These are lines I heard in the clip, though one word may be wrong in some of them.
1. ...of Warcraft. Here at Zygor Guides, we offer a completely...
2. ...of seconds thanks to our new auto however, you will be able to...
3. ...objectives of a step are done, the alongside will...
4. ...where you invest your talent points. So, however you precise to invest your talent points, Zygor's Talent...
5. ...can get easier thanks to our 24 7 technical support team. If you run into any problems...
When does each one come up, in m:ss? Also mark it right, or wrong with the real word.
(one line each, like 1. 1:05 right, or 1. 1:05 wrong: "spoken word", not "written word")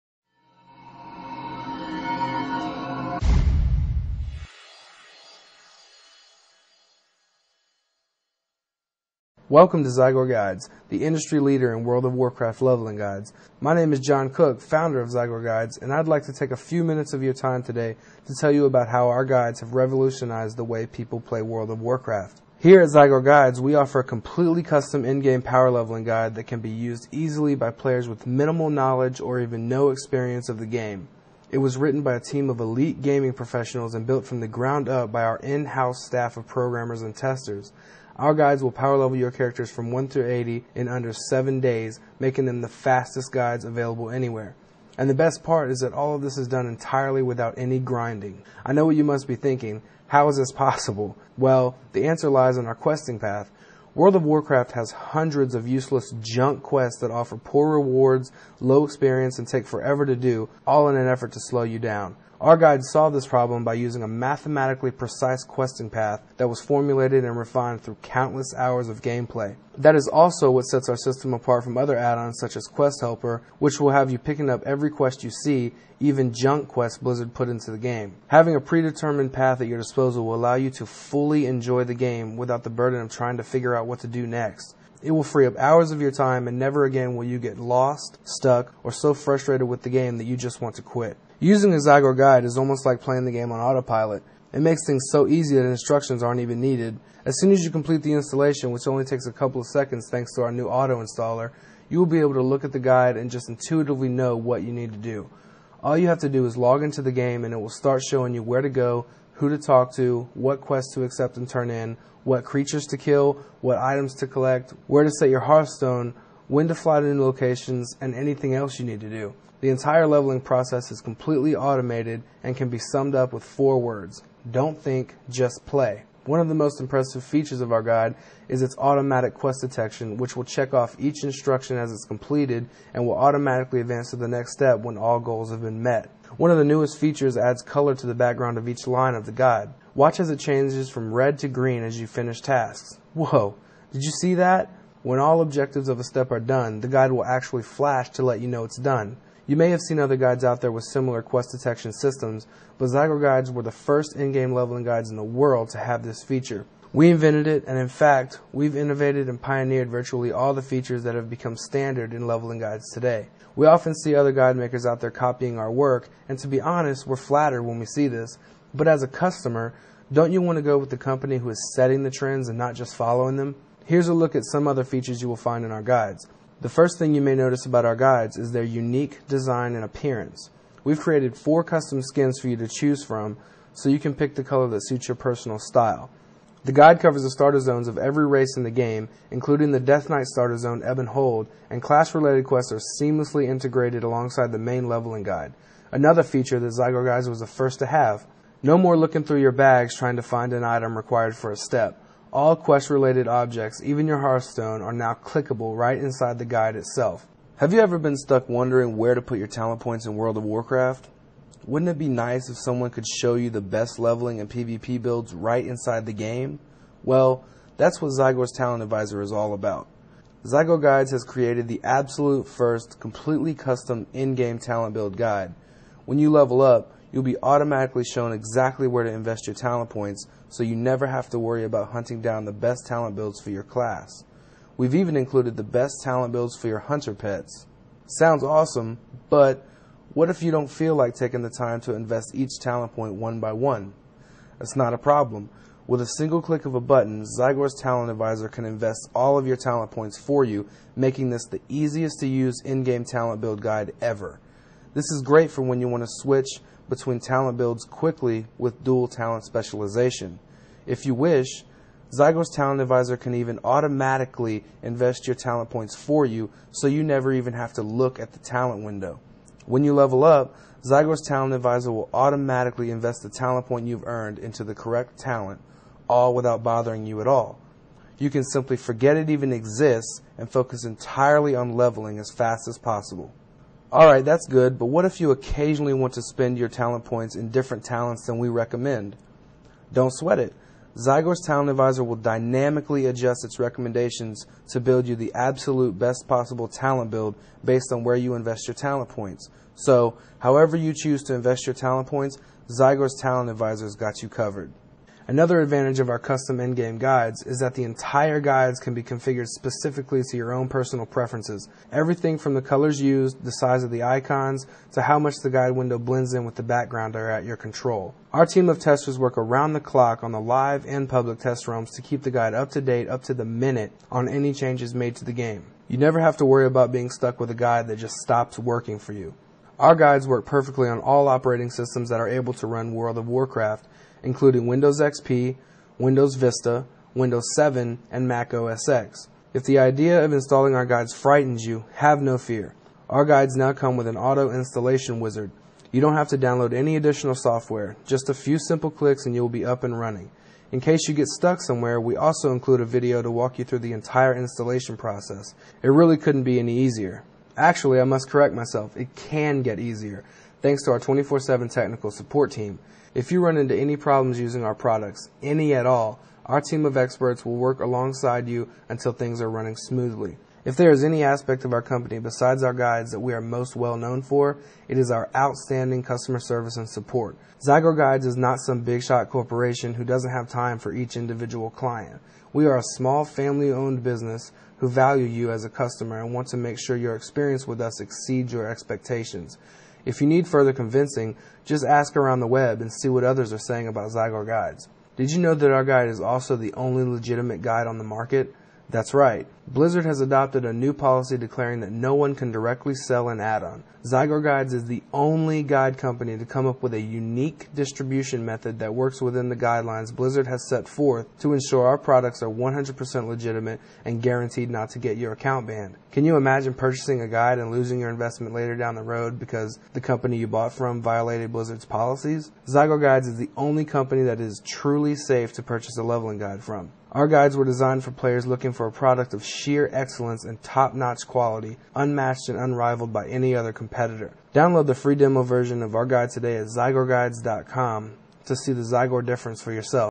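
1. 0:21 right
2. 1:39 wrong: "installer", not "however"
3. 2:25 wrong: "guide", not "alongside"
4. 4:58 wrong: "choose", not "precise"
5. 5:59 right.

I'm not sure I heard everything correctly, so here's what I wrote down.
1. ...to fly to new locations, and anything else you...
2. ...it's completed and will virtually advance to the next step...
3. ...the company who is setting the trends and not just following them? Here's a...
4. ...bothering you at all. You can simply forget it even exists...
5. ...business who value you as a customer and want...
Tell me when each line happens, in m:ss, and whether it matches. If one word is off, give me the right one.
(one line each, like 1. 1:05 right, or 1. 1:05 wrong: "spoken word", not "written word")
1. 1:56 right
2. 2:11 wrong: "automatically", not "virtually"
3. 2:50 right
4. 4:36 right
5. 6:24 right.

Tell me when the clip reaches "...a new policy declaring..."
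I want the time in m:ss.
6:40.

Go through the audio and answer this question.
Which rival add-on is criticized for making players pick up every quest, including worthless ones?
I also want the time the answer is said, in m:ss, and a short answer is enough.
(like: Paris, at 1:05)
Quest Helper, at 1:12.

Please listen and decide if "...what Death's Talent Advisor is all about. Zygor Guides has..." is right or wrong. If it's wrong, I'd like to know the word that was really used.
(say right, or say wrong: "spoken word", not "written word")
wrong: "Zygor", not "Death".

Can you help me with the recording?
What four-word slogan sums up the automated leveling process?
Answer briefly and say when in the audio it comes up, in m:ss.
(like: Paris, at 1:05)
Don't think, just play, at 2:04.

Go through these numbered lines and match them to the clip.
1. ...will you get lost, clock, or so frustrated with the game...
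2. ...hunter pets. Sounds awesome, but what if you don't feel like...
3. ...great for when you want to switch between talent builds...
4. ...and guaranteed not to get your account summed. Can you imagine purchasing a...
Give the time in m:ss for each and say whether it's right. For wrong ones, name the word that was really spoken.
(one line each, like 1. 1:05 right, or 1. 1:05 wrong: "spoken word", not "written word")
1. 1:27 wrong: "stuck", not "clock"
2. 3:56 right
3. 4:15 right
4. 6:54 wrong: "banned", not "summed".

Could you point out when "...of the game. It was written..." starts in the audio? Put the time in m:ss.
0:30.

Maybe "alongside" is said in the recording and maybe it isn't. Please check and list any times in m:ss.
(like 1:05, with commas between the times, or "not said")
3:14, 6:07.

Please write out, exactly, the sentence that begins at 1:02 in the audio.
Our guide solved this problem by using a mathematically precise questing path that was formulated and refined through countless hours of gameplay.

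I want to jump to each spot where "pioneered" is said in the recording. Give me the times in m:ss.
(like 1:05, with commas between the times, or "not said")
2:39.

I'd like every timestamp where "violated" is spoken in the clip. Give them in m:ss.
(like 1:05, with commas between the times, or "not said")
7:01.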